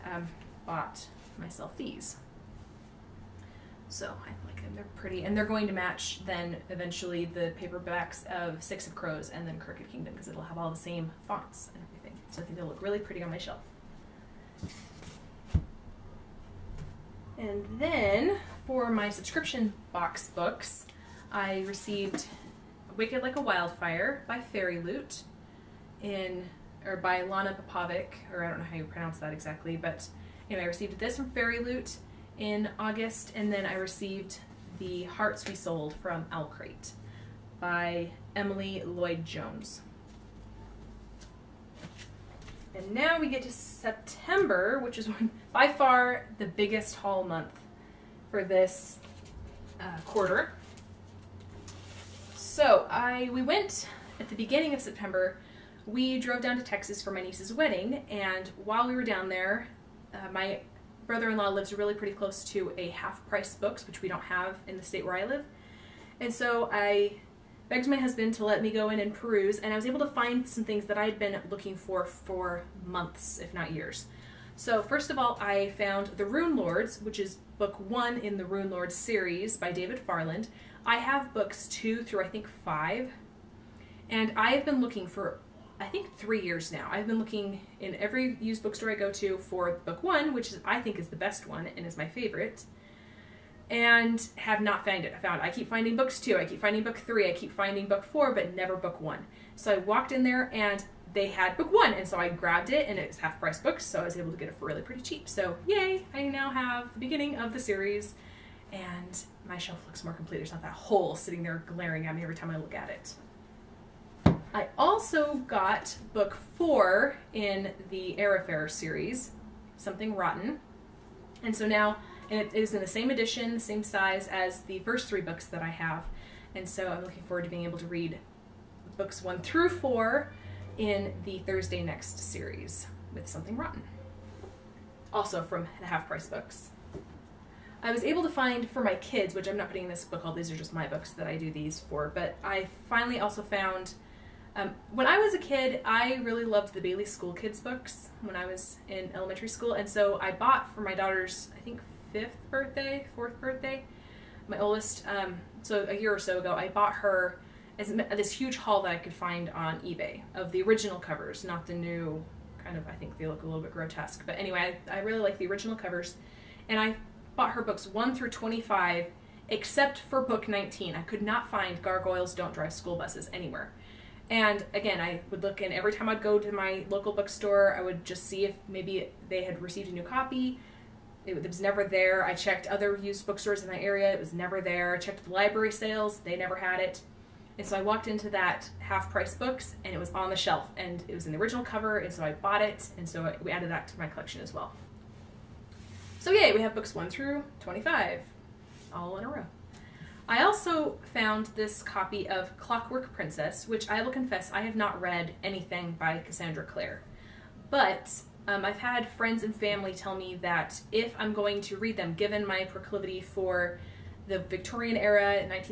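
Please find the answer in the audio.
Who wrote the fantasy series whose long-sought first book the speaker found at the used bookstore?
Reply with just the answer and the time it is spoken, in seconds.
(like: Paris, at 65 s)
David Farland, at 79 s.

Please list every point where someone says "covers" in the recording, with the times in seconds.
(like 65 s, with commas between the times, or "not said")
160 s, 165 s, 191 s.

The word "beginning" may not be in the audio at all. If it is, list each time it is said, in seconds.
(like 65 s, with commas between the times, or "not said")
54 s, 106 s.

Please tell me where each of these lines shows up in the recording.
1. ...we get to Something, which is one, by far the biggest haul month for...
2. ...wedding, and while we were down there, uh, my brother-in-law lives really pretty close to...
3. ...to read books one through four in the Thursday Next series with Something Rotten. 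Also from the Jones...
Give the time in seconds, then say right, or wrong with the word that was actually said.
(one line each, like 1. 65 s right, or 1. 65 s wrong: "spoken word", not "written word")
1. 43 s wrong: "September", not "Something"
2. 57 s right
3. 127 s wrong: "Half", not "Jones".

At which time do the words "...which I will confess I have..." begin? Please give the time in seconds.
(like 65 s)
203 s.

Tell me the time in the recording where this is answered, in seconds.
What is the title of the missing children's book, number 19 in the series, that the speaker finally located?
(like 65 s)
171 s.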